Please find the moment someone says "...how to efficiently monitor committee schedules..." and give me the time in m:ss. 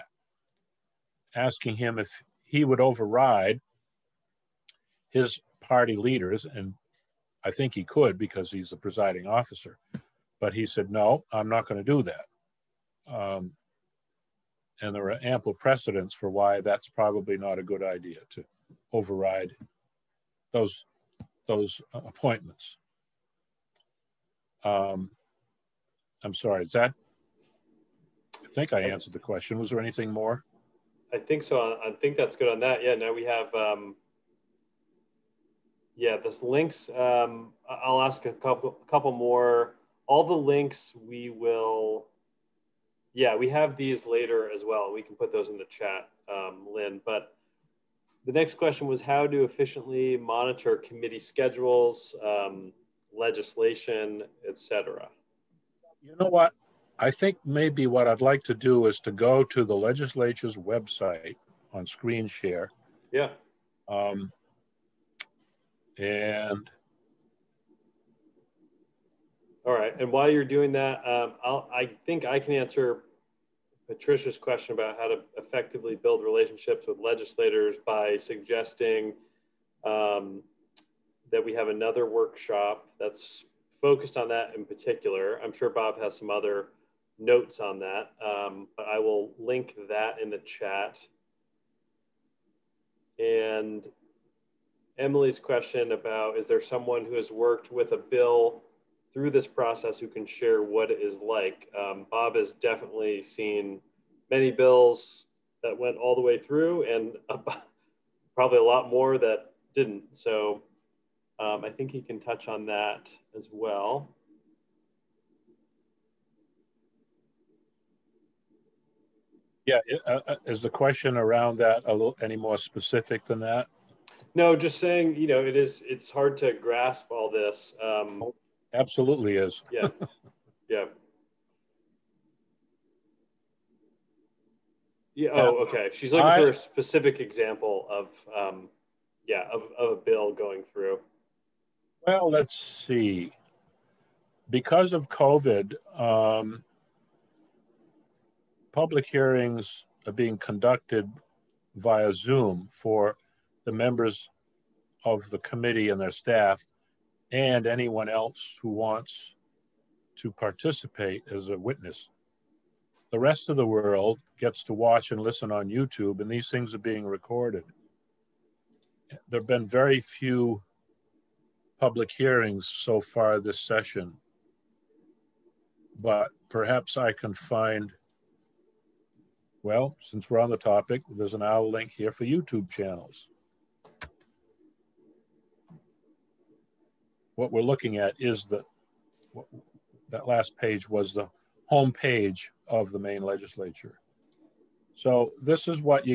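0:49.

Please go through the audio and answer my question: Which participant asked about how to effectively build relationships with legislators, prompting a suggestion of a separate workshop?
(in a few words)
Patricia.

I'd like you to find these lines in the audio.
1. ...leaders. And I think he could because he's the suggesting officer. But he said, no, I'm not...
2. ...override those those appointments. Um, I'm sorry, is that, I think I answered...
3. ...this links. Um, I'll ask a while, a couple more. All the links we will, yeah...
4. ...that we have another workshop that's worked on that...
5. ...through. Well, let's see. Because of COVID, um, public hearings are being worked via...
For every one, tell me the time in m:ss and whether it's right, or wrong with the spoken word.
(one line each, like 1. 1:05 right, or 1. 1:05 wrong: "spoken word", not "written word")
1. 0:05 wrong: "presiding", not "suggesting"
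2. 0:18 right
3. 0:36 wrong: "couple", not "while"
4. 1:21 wrong: "focused", not "worked"
5. 2:20 wrong: "conducted", not "worked".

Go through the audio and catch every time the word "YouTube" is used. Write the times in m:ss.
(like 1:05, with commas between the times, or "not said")
2:45, 3:02.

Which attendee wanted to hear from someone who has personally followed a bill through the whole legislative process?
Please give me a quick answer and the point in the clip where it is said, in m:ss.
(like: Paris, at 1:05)
Emily, at 1:34.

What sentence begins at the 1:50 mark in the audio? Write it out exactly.
So um, I think he can touch on that as well.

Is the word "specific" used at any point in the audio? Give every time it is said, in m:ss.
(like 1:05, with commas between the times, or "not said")
2:02, 2:16.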